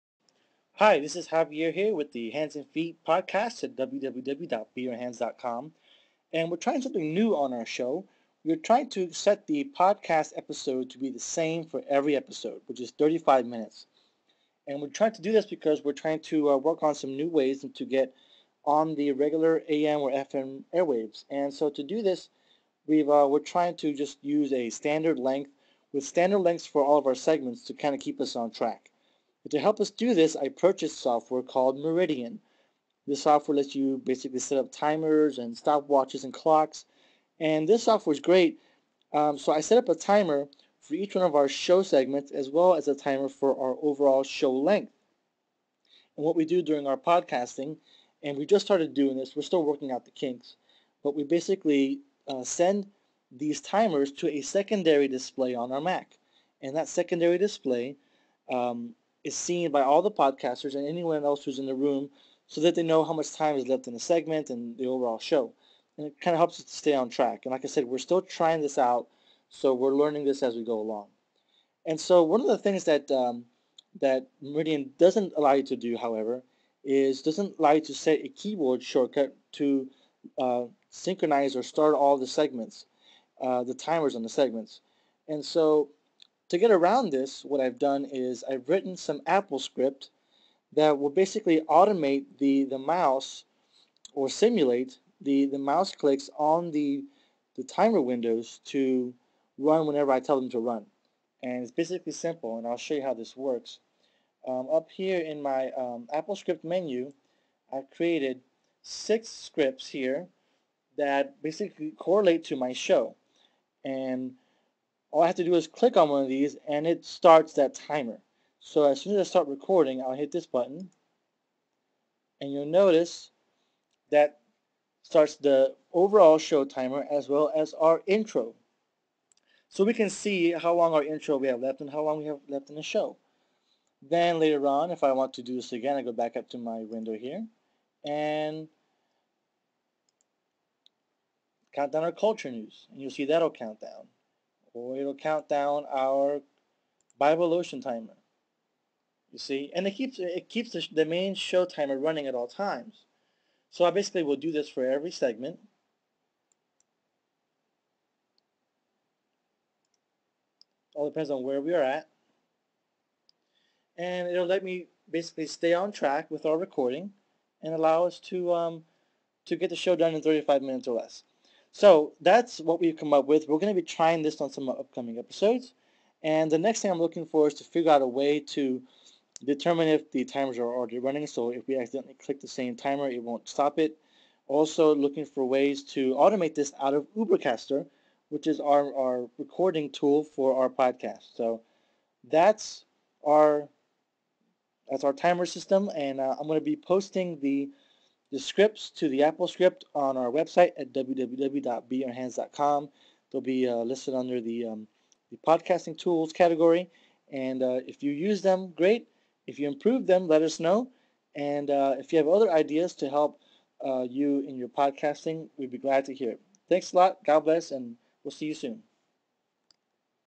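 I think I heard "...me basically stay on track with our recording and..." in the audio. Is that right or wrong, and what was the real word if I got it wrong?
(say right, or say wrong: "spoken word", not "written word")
right.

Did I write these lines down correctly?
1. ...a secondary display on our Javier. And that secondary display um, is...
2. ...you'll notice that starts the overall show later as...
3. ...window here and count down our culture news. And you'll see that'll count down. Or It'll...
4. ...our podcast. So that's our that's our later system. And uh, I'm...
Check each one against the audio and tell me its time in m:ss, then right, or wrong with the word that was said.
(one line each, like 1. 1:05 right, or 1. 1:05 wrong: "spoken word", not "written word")
1. 0:54 wrong: "Mac", not "Javier"
2. 2:02 wrong: "timer", not "later"
3. 2:16 right
4. 3:10 wrong: "timer", not "later".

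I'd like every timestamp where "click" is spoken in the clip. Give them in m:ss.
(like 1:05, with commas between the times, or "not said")
1:35, 1:55, 3:02.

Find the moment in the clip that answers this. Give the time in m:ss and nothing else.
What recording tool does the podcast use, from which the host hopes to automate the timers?
3:07.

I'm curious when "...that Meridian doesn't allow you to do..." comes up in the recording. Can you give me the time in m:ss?
1:13.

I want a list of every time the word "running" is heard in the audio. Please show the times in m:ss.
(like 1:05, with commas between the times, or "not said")
2:31, 3:00.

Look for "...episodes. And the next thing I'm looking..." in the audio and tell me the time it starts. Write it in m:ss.
2:55.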